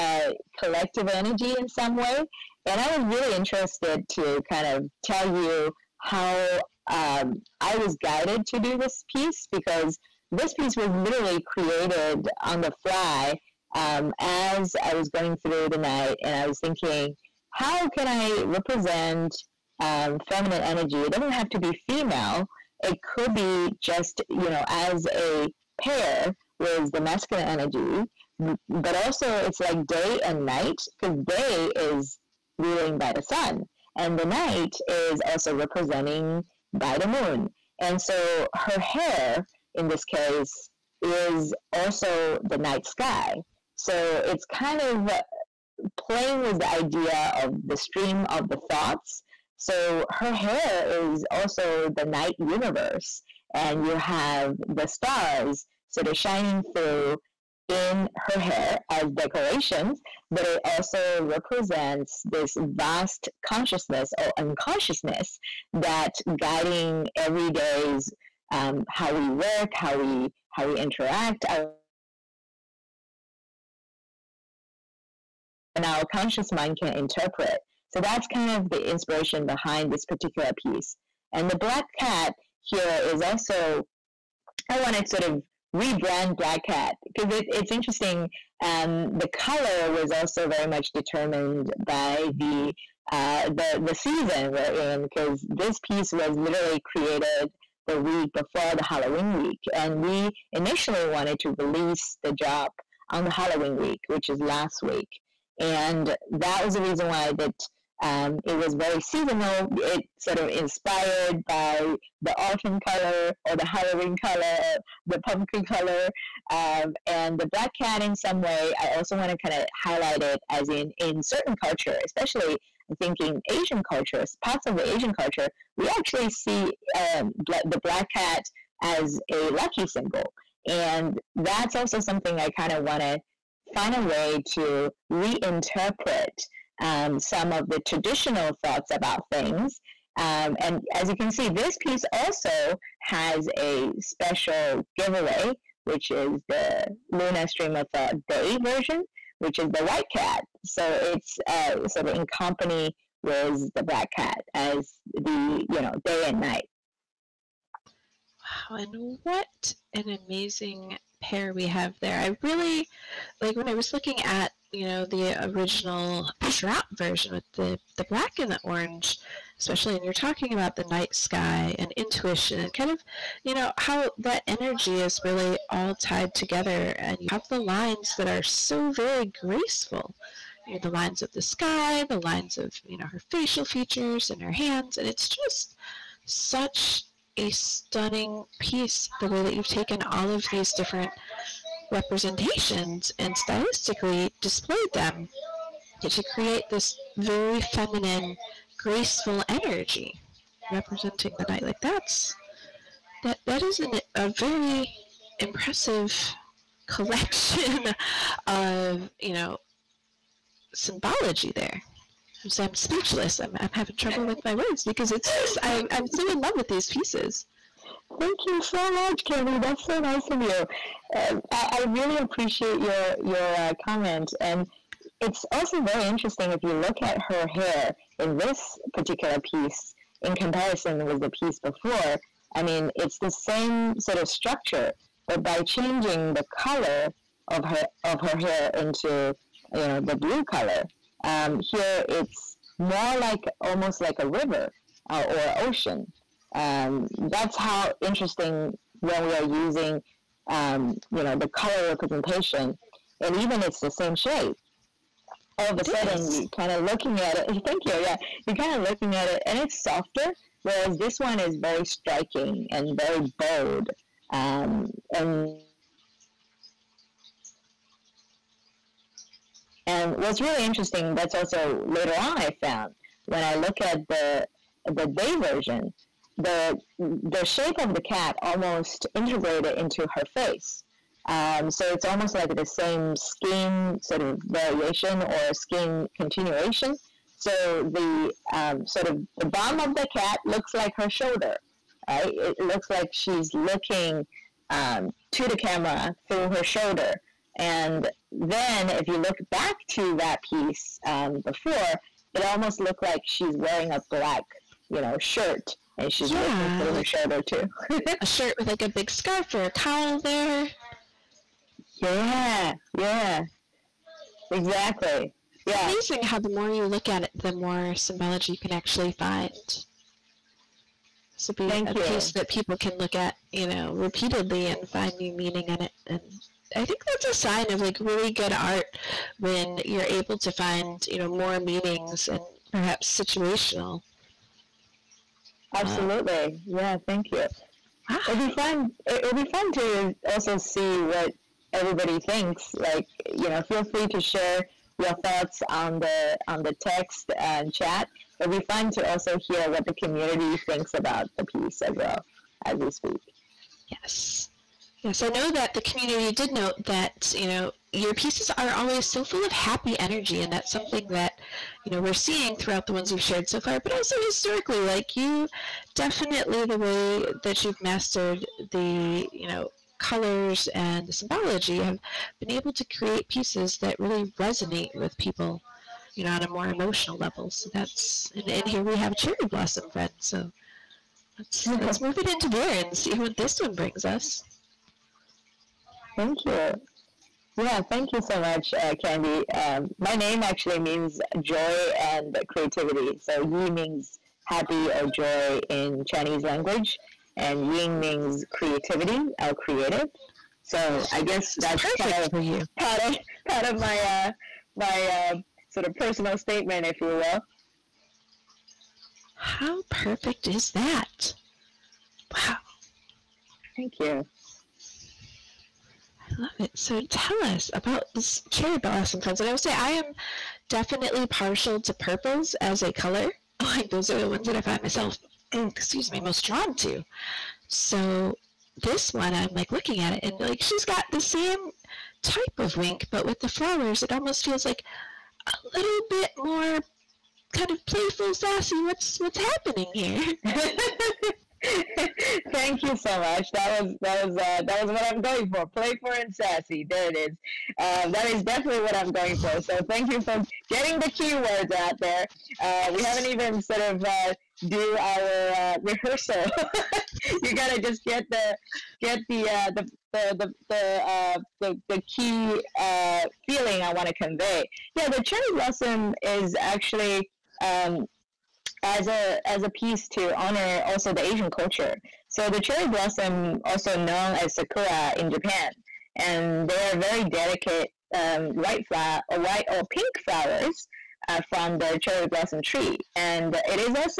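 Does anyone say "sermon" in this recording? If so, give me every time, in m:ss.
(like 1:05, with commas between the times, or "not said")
not said.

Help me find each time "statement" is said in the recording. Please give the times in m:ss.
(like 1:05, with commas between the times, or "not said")
6:46.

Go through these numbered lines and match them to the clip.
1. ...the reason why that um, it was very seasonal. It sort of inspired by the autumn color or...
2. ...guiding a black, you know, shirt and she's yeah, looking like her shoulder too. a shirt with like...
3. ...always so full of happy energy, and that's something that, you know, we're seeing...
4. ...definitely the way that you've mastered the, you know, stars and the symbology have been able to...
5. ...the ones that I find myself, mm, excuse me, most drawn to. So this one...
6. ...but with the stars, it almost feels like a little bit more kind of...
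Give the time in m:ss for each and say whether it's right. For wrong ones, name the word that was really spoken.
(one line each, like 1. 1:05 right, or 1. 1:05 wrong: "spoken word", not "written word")
1. 1:46 right
2. 5:03 wrong: "wearing", not "guiding"
3. 5:58 right
4. 6:05 wrong: "colors", not "stars"
5. 7:04 right
6. 7:13 wrong: "flowers", not "stars".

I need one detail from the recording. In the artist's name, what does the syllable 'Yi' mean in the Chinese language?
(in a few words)
Happy or joy.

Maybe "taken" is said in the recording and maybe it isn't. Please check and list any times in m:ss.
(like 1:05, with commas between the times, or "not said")
3:09.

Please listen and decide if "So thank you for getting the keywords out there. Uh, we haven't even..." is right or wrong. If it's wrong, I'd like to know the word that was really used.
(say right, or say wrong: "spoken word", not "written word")
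right.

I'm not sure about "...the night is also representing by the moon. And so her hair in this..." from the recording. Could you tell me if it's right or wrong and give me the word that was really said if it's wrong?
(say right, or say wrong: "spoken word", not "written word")
right.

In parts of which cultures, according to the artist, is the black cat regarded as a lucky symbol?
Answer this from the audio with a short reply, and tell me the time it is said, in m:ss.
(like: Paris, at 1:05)
Asian cultures, at 2:03.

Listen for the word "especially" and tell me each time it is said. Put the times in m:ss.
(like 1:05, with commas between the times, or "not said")
2:02, 2:49.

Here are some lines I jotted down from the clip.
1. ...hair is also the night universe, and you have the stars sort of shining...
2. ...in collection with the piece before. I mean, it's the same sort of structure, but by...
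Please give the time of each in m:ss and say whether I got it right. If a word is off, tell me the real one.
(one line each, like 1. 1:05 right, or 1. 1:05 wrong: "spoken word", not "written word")
1. 0:50 right
2. 3:50 wrong: "comparison", not "collection".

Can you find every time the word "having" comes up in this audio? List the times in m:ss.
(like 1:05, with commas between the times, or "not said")
3:33.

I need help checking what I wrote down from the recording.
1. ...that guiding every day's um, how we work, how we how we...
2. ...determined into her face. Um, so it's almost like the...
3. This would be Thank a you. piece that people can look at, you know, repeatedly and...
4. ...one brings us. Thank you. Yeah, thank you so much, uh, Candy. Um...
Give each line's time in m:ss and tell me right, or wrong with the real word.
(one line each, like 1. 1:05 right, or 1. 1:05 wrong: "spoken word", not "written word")
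1. 1:05 right
2. 4:39 wrong: "integrated", not "determined"
3. 5:19 right
4. 6:23 right.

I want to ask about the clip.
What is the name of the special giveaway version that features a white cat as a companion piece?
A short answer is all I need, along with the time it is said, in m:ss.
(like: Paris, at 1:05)
Luna Stream of Thought Day version, at 2:27.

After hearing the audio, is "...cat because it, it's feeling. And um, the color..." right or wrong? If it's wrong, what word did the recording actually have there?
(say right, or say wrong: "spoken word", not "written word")
wrong: "interesting", not "feeling".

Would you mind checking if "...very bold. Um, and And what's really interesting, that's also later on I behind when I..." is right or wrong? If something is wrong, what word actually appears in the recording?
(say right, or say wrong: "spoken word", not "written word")
wrong: "found", not "behind".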